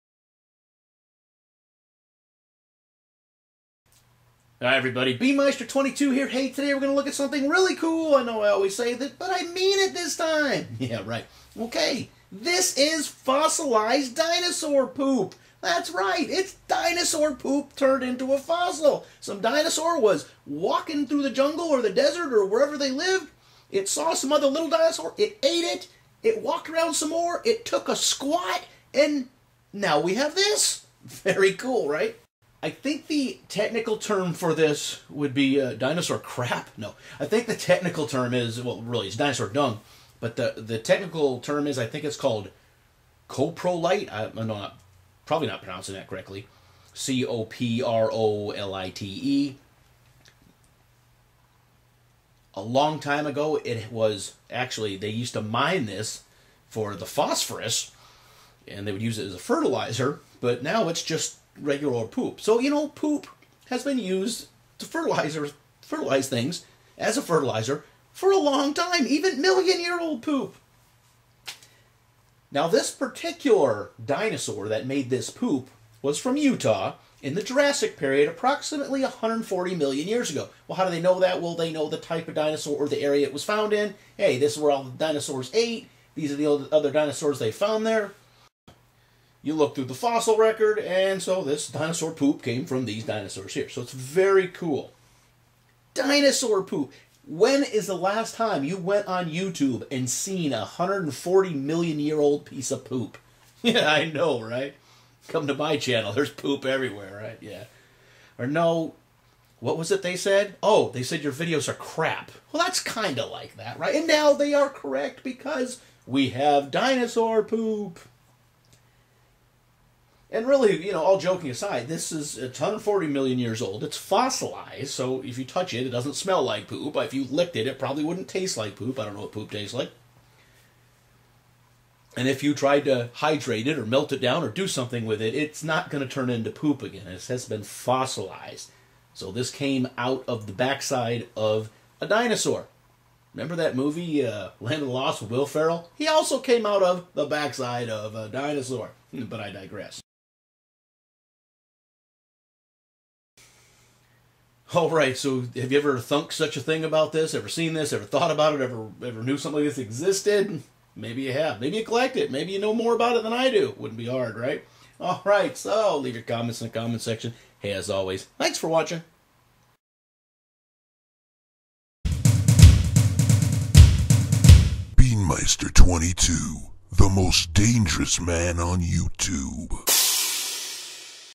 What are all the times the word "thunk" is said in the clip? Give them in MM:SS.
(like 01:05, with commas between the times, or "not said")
02:35.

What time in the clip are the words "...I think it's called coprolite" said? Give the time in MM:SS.
00:41.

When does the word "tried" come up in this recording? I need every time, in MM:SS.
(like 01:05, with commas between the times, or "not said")
02:12.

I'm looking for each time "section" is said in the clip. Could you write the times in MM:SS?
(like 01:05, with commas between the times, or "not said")
02:47.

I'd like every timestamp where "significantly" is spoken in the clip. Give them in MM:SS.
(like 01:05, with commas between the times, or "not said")
not said.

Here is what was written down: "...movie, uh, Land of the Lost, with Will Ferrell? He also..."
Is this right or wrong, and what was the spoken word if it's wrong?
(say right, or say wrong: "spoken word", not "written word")
right.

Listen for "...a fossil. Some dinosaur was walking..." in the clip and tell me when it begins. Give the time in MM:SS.
00:18.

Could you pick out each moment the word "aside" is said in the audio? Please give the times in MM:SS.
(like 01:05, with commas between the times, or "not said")
02:01.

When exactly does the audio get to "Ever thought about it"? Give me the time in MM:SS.
02:37.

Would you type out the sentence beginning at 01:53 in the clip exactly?
And now they are correct because we have dinosaur poop.